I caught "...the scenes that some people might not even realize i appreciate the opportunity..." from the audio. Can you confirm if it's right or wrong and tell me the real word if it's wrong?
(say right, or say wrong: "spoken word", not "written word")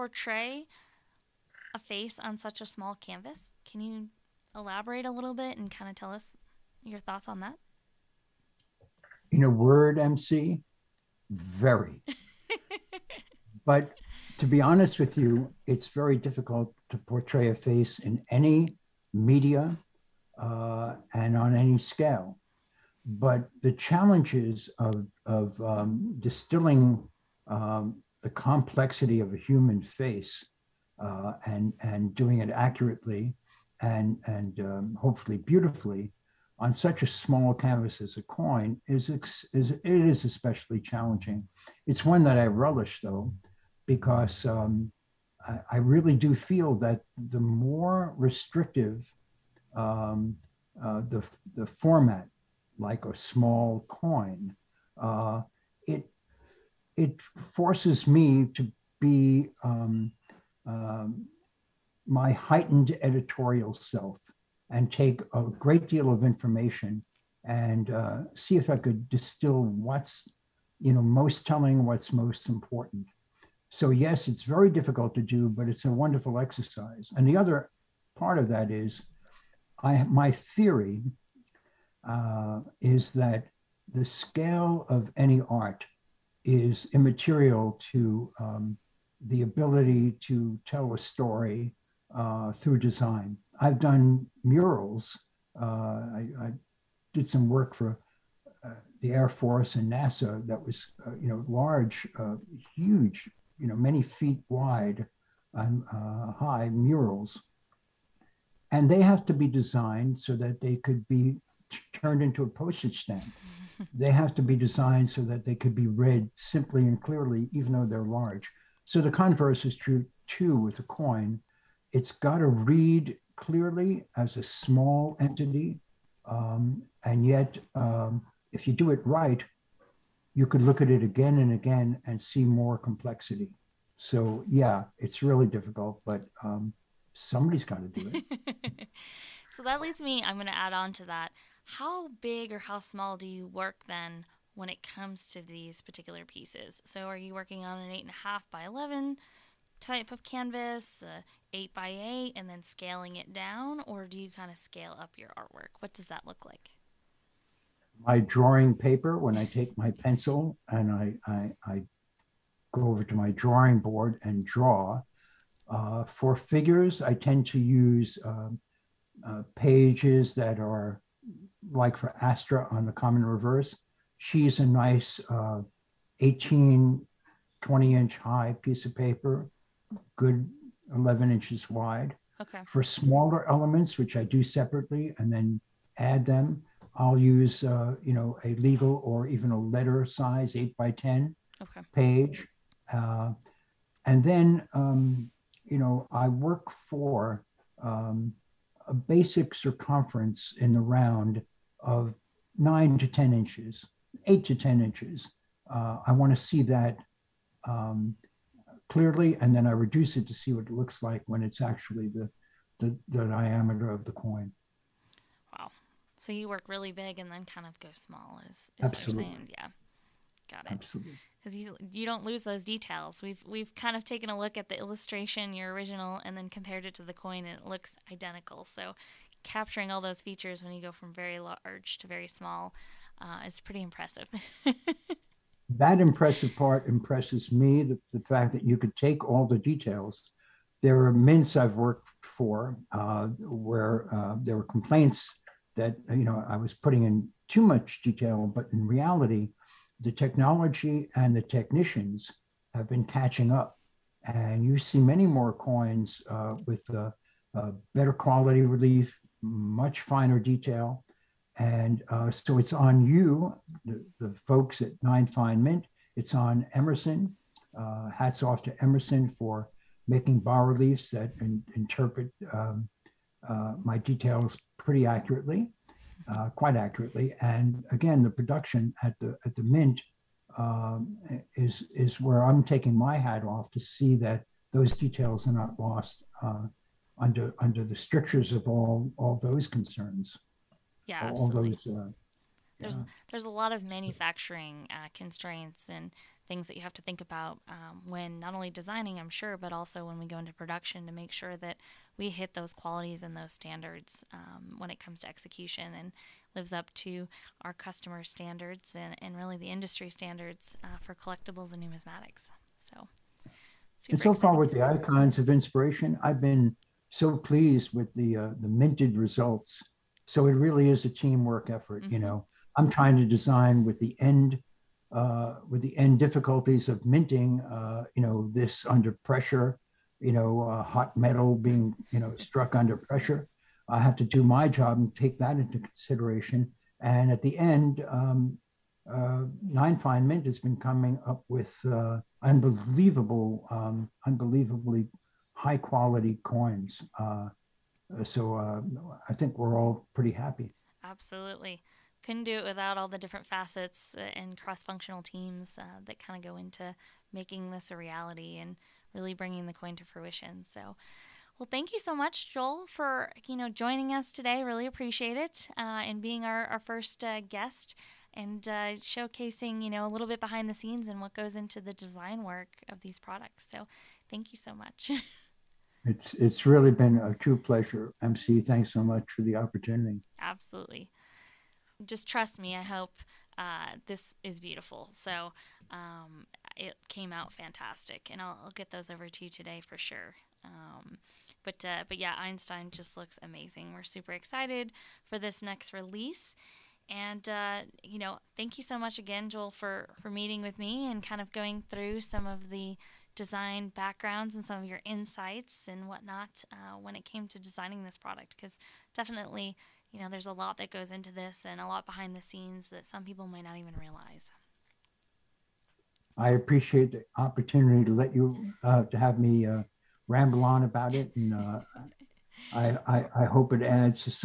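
right.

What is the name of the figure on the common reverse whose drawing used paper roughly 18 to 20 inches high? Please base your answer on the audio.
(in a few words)
Astra.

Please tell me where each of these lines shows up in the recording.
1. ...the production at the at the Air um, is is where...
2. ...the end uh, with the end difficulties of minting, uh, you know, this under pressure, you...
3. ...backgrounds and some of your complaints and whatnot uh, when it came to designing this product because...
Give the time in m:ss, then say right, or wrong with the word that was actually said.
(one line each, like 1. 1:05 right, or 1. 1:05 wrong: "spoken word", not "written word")
1. 4:38 wrong: "Mint", not "Air"
2. 5:23 right
3. 6:43 wrong: "insights", not "complaints".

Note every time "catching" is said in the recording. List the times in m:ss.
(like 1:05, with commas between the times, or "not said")
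4:13.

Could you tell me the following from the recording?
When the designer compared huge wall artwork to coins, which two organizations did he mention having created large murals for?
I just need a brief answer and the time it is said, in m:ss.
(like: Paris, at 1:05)
Air Force and NASA, at 1:39.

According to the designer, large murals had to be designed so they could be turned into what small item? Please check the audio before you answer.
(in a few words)
postage stamp.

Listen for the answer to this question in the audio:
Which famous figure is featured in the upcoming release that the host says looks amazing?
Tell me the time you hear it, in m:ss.
6:32.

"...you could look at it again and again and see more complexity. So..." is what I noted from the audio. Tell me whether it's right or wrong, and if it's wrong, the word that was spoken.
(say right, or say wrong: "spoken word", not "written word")
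right.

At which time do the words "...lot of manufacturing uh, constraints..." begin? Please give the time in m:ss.
4:53.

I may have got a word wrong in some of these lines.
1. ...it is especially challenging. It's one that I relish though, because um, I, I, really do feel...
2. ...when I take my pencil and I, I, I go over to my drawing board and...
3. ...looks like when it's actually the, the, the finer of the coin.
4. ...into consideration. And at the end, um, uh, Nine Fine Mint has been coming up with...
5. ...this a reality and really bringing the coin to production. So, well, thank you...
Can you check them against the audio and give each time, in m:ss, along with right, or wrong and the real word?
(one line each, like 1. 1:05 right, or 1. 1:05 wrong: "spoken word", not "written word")
1. 0:39 right
2. 2:39 right
3. 3:30 wrong: "diameter", not "finer"
4. 5:35 right
5. 5:57 wrong: "fruition", not "production".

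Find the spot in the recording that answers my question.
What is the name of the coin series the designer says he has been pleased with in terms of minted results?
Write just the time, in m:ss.
5:14.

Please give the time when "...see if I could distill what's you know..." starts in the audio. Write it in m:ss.
1:08.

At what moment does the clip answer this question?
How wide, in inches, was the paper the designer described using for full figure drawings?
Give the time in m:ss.
3:00.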